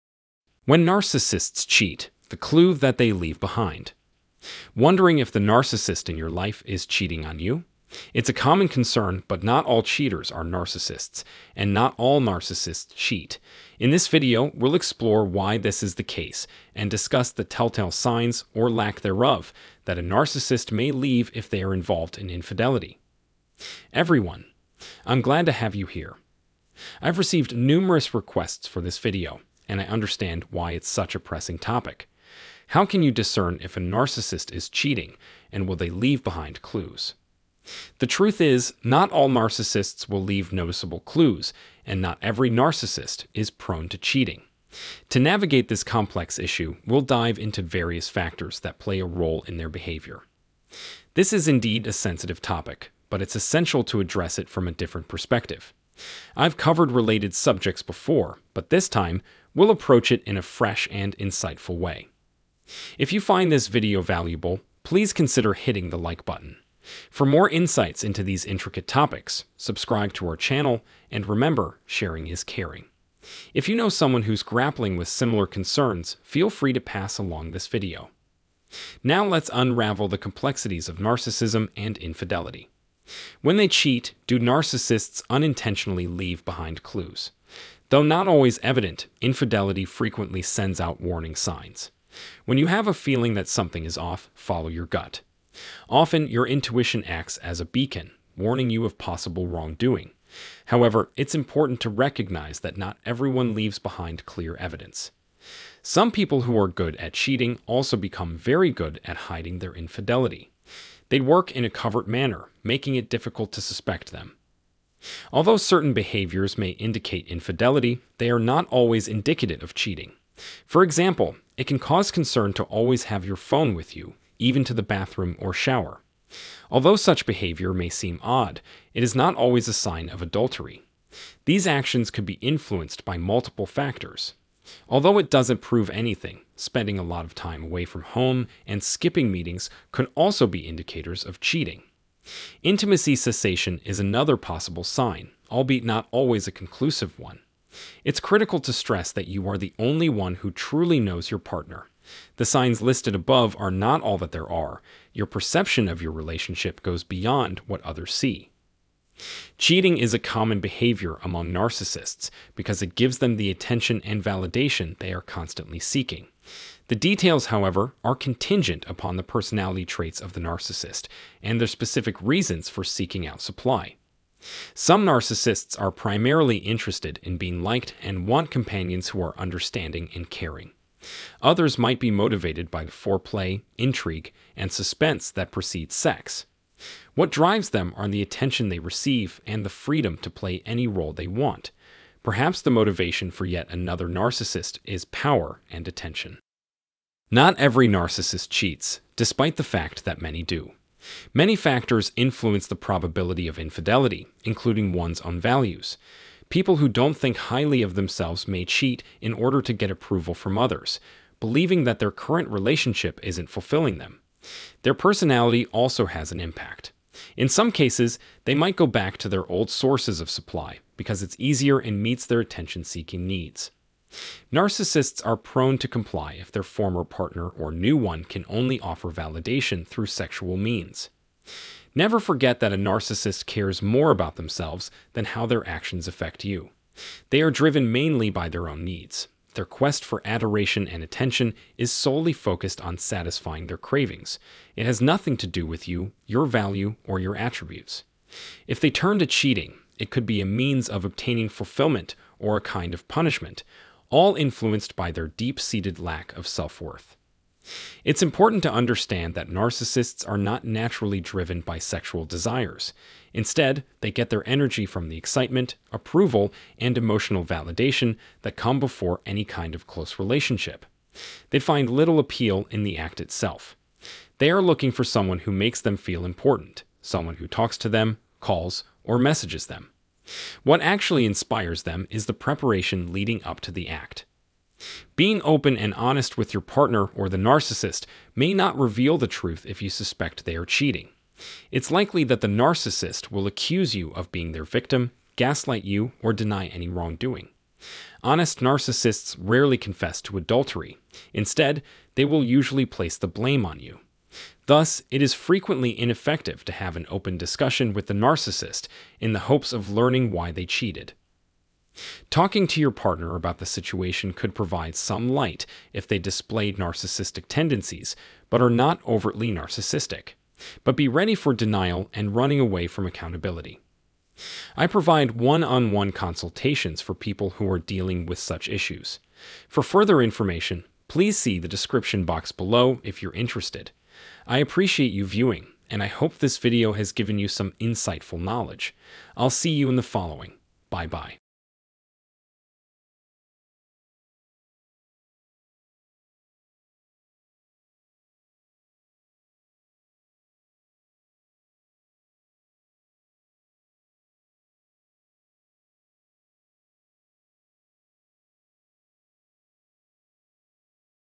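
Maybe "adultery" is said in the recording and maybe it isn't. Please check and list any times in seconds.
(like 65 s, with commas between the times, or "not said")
130 s, 300 s.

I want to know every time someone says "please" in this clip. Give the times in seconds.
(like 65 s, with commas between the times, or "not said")
64 s, 331 s.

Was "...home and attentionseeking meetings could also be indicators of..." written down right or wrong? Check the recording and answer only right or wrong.
wrong.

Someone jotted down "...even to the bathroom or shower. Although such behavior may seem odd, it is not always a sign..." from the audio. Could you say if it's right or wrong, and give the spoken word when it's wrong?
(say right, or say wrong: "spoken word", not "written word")
right.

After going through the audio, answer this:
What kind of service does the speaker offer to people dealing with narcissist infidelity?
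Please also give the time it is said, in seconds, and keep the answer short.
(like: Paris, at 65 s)
one-on-one consultations, at 325 s.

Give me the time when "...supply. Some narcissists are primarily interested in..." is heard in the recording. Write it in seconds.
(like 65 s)
173 s.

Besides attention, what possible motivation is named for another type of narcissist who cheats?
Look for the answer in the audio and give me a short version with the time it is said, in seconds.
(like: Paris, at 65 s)
power, at 195 s.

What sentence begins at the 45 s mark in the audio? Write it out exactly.
To navigate this complex issue, we'll dive into various factors that play a role in their behavior.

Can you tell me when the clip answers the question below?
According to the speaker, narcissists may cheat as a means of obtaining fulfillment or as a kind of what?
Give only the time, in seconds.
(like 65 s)
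253 s.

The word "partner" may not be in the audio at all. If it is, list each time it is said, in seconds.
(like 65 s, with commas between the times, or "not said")
151 s, 227 s, 286 s, 312 s.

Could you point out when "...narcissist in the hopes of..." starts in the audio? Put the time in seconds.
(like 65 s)
308 s.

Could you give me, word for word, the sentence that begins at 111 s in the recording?
They work in a covert manner, making it difficult to suspect them.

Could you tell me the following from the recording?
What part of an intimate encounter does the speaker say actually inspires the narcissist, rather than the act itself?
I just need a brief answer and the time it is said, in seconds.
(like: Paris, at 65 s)
the preparation, at 282 s.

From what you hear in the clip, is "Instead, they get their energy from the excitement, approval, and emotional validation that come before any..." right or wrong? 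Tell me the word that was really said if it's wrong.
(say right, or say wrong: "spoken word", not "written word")
right.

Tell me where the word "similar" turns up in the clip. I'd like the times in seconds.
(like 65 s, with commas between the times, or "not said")
75 s.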